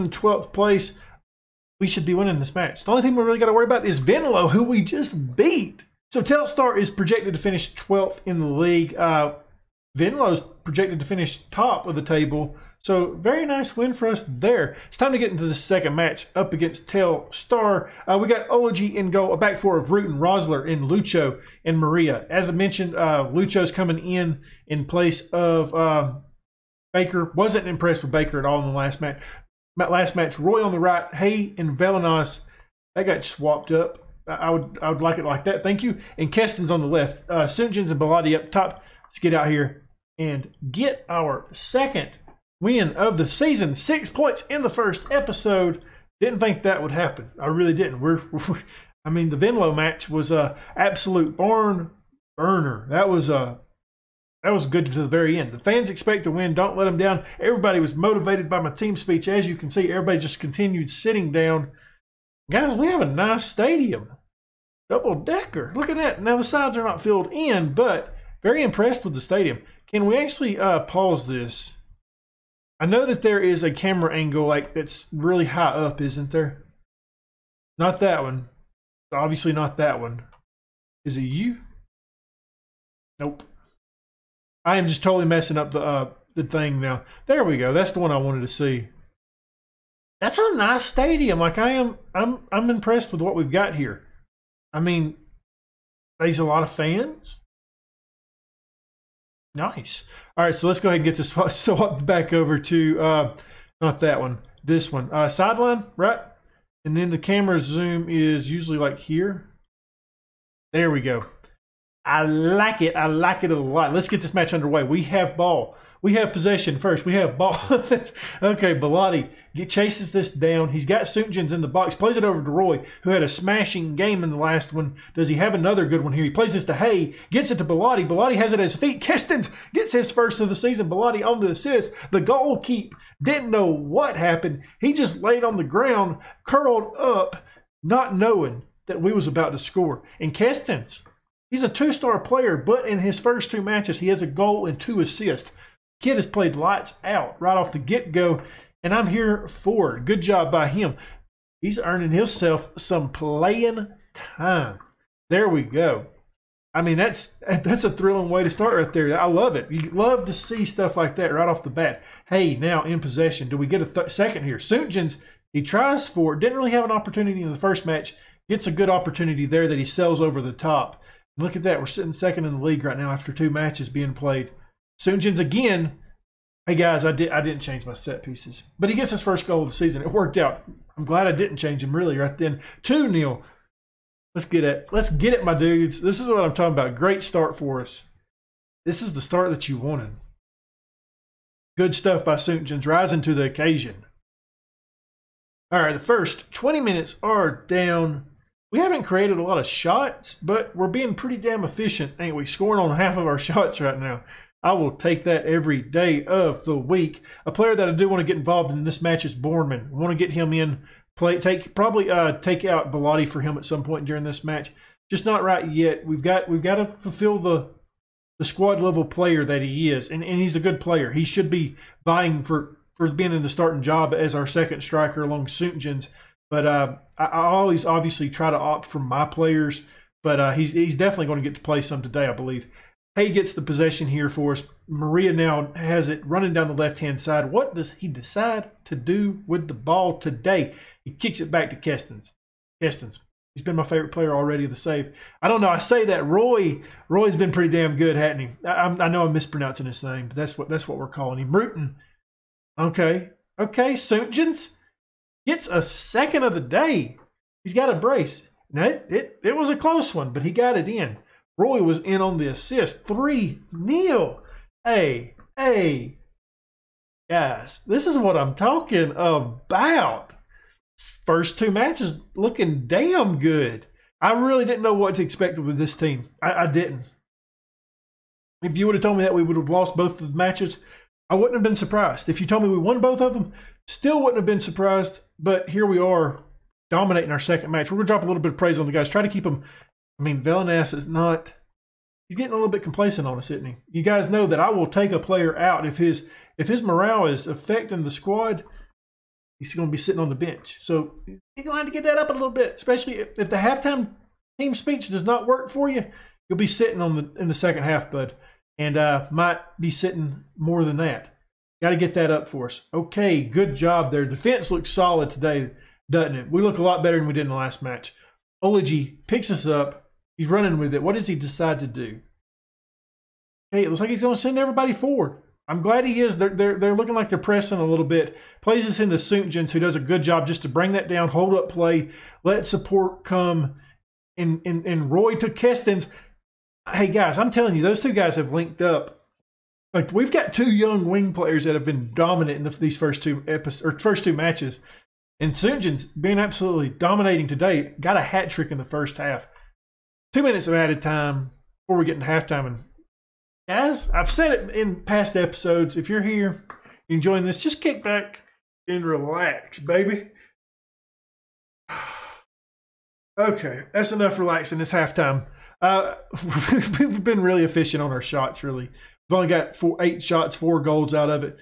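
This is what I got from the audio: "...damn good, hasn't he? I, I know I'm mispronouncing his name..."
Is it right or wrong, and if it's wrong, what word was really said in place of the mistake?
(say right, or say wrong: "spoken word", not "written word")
right.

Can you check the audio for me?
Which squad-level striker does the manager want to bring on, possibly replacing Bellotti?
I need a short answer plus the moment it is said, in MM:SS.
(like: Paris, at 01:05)
Borman, at 03:29.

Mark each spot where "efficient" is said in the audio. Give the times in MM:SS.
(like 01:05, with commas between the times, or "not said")
03:21, 06:07.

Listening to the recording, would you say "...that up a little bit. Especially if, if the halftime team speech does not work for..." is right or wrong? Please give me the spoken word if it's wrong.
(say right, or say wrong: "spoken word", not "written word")
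right.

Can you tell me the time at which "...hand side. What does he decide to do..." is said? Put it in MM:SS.
03:56.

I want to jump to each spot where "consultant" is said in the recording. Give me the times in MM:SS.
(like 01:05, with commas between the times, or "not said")
not said.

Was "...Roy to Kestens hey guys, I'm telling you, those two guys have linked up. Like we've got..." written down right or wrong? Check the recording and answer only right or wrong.
right.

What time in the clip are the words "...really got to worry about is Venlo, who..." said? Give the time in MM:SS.
00:03.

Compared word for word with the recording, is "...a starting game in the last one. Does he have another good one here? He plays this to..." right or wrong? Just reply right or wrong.
wrong.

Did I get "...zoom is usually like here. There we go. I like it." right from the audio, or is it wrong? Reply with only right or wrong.
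right.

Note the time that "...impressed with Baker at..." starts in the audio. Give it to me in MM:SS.
00:27.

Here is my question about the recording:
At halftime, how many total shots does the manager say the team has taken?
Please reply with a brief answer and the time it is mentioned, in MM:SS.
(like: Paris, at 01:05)
8, at 06:10.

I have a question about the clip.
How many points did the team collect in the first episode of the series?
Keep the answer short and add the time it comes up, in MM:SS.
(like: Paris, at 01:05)
6, at 00:43.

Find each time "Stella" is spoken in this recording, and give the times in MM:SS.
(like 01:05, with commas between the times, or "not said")
not said.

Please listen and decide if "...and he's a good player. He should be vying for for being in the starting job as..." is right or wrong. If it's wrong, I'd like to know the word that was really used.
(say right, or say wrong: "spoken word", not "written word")
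right.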